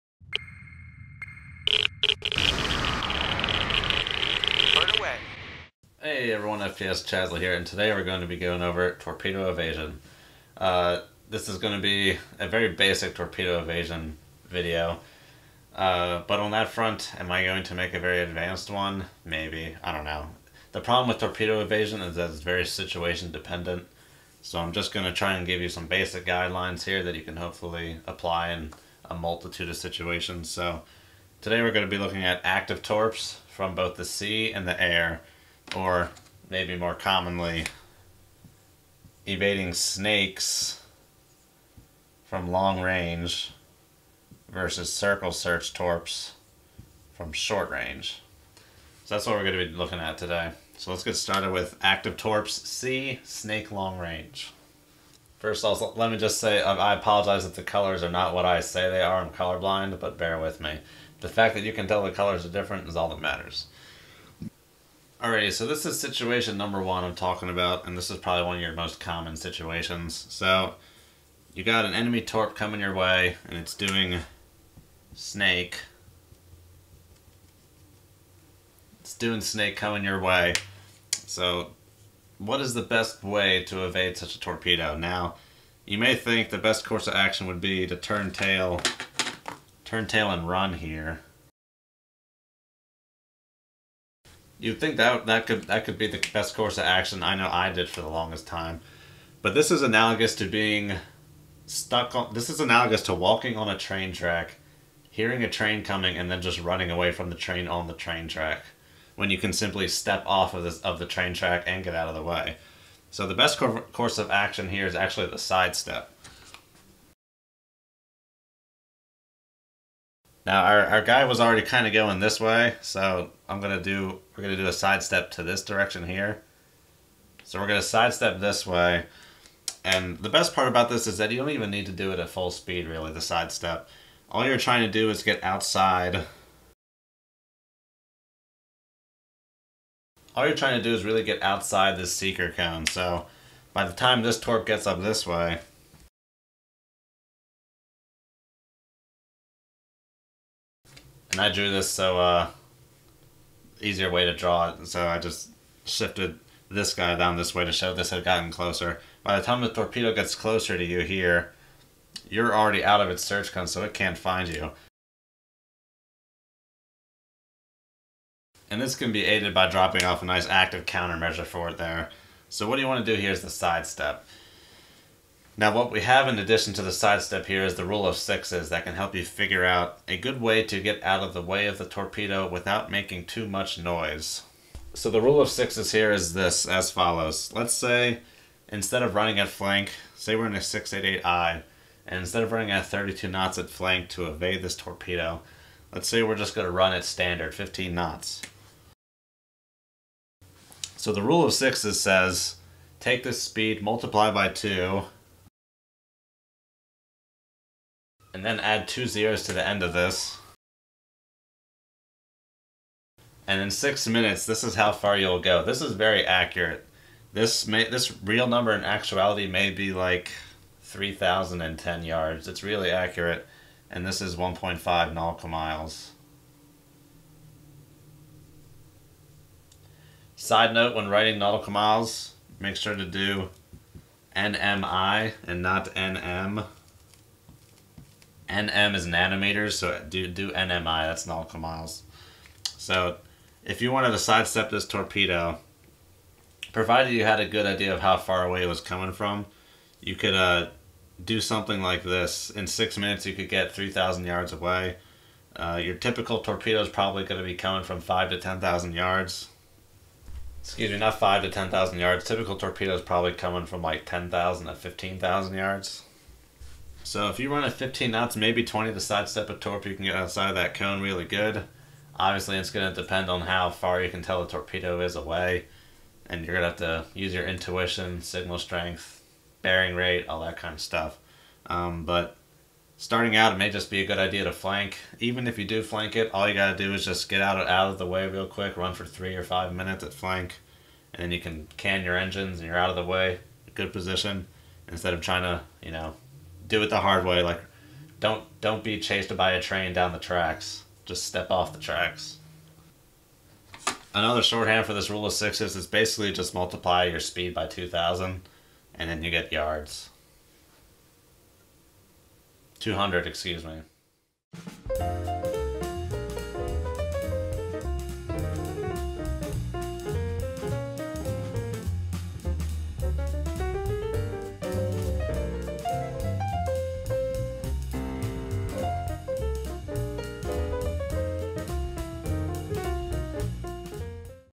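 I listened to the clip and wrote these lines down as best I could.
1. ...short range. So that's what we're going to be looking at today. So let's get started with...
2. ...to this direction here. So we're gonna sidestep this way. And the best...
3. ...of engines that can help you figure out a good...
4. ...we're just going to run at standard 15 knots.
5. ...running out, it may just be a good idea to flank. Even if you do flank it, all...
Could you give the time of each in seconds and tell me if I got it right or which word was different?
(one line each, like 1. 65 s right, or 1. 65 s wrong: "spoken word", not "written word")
1. 47 s right
2. 125 s right
3. 178 s wrong: "sixes", not "engines"
4. 196 s right
5. 282 s wrong: "starting", not "running".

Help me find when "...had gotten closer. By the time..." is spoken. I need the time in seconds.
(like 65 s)
158 s.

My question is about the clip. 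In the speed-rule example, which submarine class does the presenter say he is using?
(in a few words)
688i.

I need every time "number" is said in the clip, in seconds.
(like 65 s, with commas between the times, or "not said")
66 s, 218 s.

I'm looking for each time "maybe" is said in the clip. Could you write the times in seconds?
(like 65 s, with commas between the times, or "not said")
19 s, 36 s, 268 s.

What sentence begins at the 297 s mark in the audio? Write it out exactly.
Like, don't don't be chased by a train down the tracks.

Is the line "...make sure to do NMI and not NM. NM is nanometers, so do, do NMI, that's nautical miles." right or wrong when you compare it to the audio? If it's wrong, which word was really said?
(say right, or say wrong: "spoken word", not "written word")
right.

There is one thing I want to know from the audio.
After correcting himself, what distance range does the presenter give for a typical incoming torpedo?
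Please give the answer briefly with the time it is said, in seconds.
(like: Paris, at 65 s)
10,000 to 15,000 yards, at 264 s.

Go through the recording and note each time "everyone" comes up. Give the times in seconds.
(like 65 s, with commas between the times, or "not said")
6 s.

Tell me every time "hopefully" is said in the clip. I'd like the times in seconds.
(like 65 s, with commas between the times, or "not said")
27 s.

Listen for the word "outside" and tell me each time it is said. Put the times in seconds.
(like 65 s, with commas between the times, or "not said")
135 s, 141 s, 270 s.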